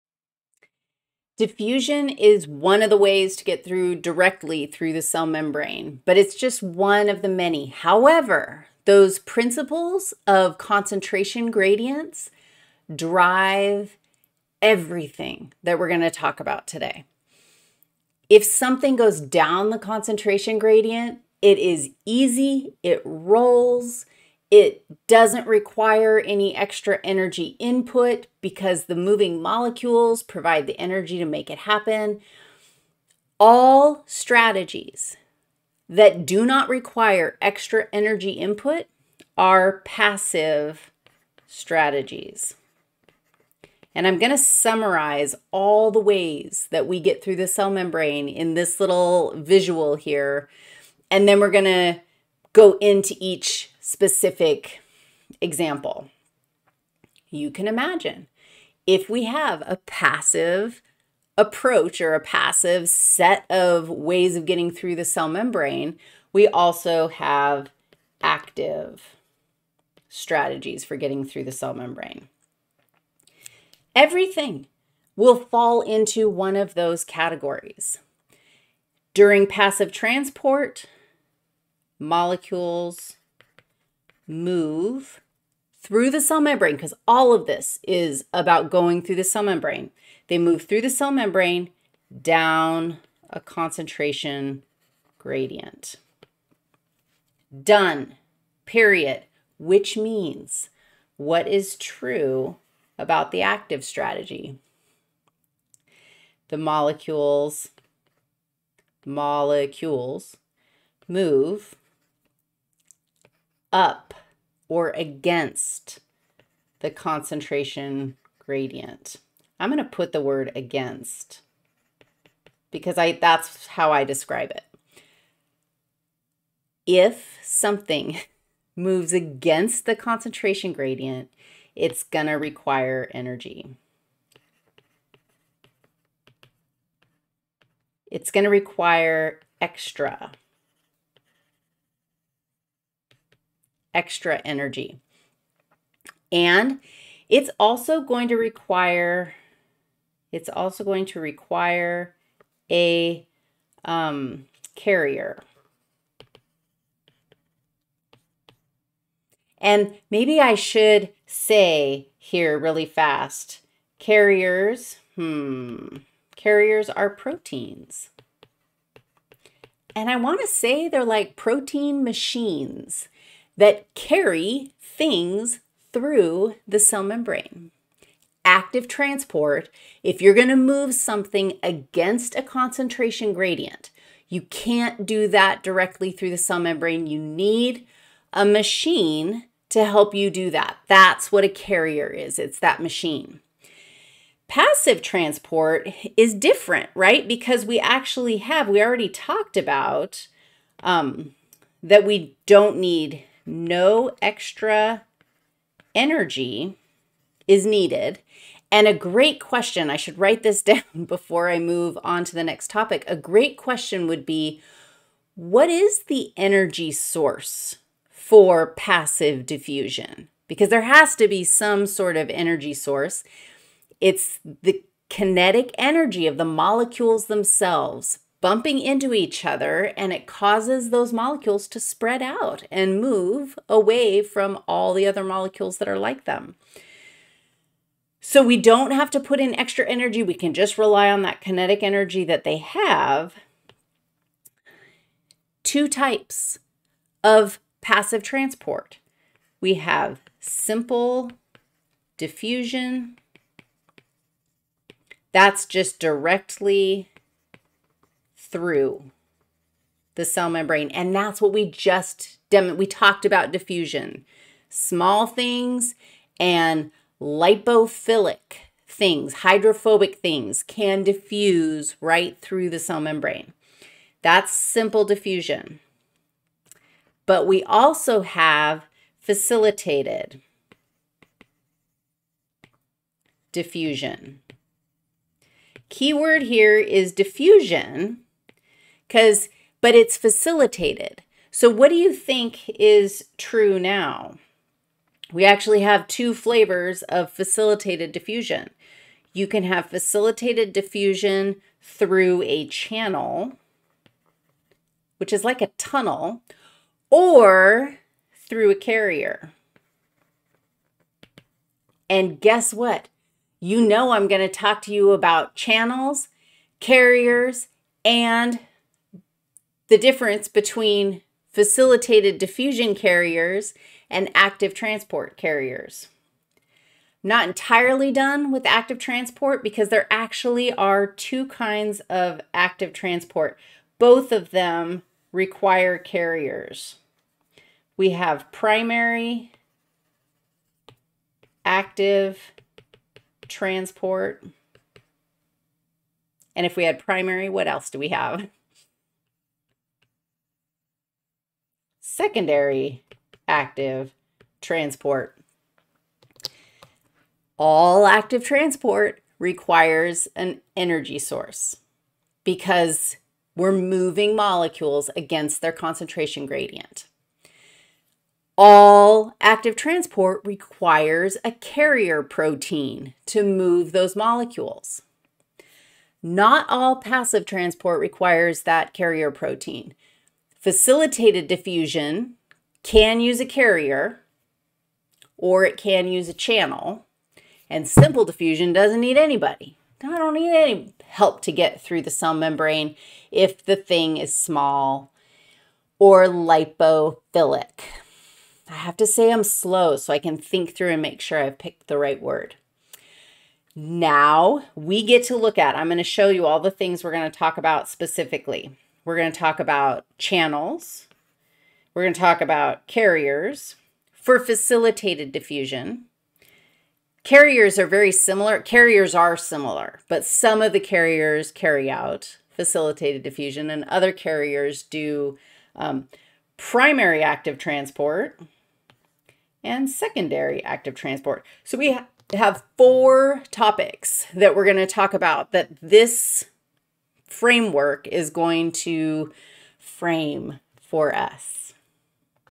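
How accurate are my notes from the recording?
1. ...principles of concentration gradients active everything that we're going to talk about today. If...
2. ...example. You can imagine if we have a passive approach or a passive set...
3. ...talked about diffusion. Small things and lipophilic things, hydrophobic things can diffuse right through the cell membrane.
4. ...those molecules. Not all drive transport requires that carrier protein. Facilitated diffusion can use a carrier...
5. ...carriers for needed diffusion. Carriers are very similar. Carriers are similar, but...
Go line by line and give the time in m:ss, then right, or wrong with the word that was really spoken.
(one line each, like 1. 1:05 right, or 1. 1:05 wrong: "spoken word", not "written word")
1. 0:09 wrong: "drive", not "active"
2. 0:55 right
3. 4:22 right
4. 6:13 wrong: "passive", not "drive"
5. 6:52 wrong: "facilitated", not "needed".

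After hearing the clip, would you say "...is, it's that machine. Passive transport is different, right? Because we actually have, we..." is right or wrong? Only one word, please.
right.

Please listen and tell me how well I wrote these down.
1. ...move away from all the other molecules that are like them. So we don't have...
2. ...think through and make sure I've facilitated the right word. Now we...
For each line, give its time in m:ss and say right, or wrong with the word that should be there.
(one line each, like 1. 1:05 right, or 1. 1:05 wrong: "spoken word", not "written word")
1. 3:52 right
2. 6:40 wrong: "picked", not "facilitated".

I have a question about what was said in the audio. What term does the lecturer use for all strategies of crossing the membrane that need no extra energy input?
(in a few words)
Passive strategies.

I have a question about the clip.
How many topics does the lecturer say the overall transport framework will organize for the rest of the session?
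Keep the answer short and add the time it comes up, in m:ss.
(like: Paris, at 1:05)
4, at 7:12.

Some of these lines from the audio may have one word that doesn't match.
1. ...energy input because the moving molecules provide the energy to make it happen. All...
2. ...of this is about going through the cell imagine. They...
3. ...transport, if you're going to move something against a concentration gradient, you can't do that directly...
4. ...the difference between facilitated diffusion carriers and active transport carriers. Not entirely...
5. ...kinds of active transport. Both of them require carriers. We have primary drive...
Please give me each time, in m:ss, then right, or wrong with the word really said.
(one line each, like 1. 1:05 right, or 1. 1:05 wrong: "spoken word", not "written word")
1. 0:27 right
2. 1:27 wrong: "membrane", not "imagine"
3. 2:58 right
4. 5:19 right
5. 5:31 wrong: "active", not "drive".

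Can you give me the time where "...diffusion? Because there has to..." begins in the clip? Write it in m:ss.
3:39.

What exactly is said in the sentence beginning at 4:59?
You can have facilitated diffusion through a channel, which is like a tunnel, or through a carrier.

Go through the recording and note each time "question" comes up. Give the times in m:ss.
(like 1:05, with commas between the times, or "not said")
3:29, 3:33.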